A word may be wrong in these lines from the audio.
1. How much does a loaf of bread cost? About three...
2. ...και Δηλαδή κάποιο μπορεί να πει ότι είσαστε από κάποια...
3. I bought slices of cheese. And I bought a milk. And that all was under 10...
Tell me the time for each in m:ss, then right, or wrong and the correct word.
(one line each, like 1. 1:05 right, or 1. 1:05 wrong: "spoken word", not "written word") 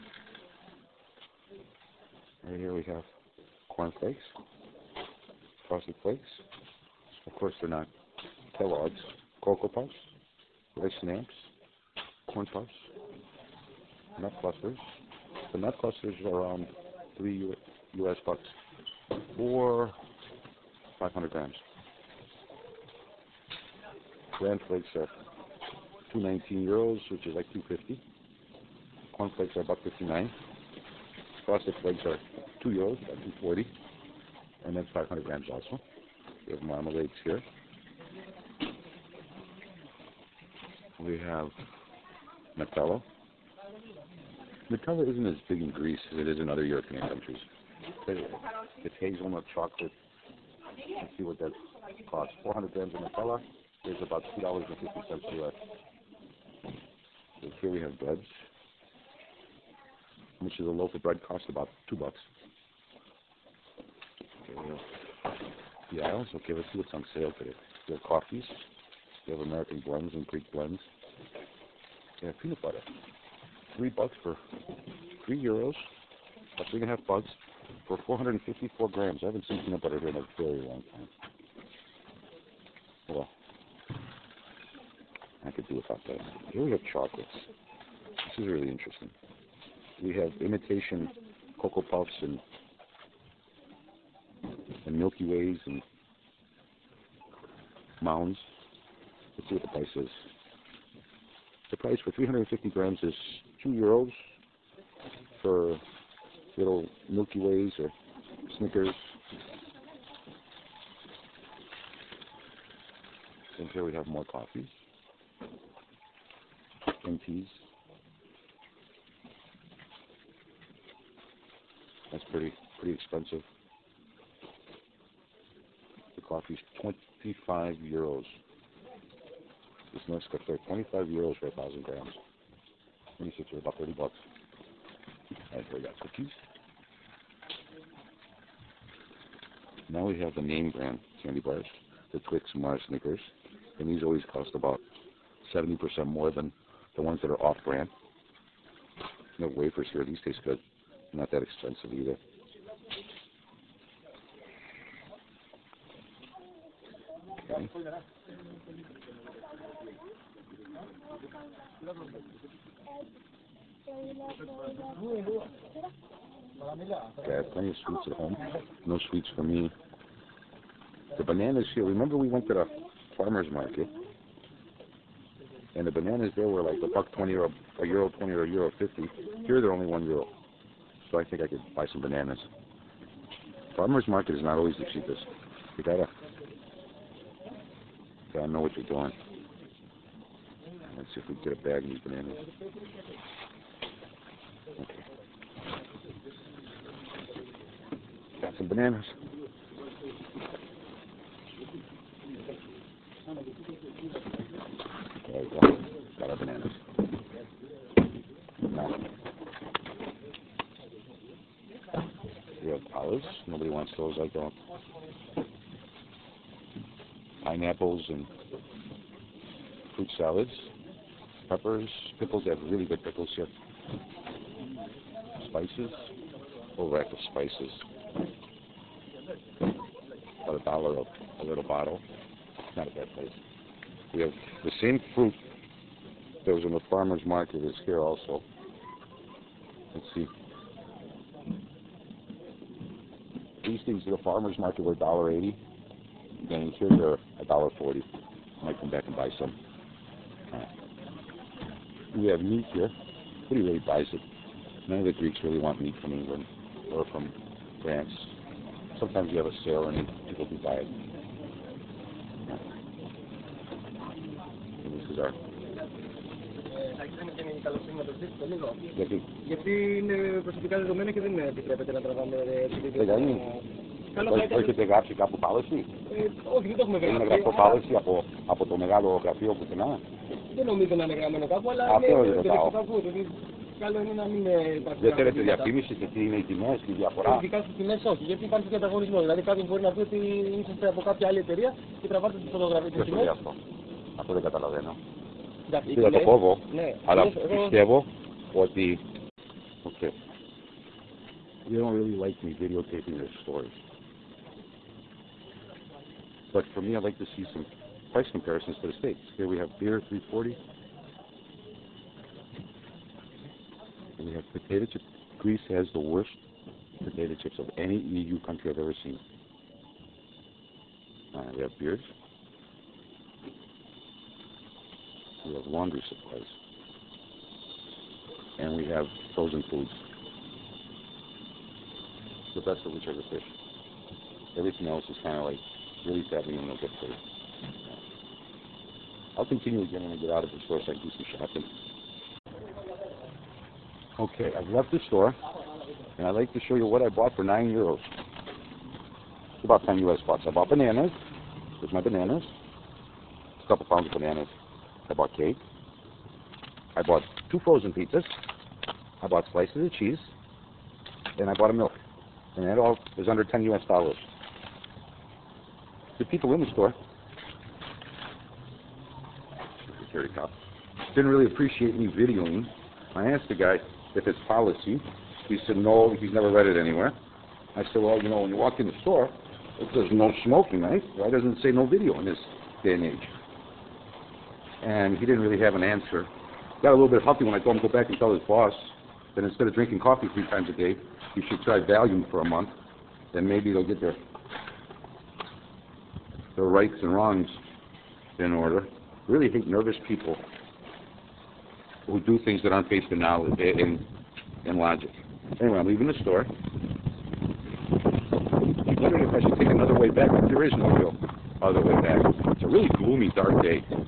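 1. 1:00 wrong: "two", not "three"
2. 4:48 right
3. 5:59 right.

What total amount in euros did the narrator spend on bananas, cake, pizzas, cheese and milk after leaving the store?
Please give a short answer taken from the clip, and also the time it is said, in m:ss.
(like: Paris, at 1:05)
9 euros, at 5:47.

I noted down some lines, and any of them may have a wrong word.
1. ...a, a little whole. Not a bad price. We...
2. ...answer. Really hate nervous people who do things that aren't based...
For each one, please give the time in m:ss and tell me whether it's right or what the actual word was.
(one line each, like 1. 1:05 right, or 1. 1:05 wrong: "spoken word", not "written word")
1. 3:50 wrong: "bottle", not "whole"
2. 6:38 wrong: "order", not "answer".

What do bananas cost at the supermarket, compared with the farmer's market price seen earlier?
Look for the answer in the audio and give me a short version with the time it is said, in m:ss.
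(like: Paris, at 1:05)
1 euro, at 2:59.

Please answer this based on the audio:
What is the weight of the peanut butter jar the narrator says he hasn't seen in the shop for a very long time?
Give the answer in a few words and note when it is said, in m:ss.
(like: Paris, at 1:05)
454 grams, at 1:18.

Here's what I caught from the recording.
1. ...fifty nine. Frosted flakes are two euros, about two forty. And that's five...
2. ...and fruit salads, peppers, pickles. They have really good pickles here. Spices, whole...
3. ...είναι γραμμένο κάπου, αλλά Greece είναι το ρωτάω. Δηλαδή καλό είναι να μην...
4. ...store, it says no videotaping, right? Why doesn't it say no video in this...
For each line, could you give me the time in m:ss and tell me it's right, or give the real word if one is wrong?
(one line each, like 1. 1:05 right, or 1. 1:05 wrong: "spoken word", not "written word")
1. 0:29 right
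2. 3:38 right
3. 4:41 wrong: "Αυτό", not "Greece"
4. 6:19 wrong: "smoking", not "videotaping".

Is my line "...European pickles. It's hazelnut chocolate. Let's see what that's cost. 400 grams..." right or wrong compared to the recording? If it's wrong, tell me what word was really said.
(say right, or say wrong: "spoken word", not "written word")
wrong: "countries", not "pickles".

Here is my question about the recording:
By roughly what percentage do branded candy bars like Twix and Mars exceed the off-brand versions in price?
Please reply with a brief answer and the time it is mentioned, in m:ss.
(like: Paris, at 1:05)
70%, at 2:25.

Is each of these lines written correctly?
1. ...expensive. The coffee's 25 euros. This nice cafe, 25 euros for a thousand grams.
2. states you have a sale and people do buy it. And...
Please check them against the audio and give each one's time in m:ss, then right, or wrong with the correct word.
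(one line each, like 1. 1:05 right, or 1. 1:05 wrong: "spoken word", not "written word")
1. 2:02 right
2. 4:18 wrong: "sometimes", not "states".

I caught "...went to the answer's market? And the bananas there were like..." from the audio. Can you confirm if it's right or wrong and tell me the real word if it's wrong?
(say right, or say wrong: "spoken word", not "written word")
wrong: "farmer", not "answer".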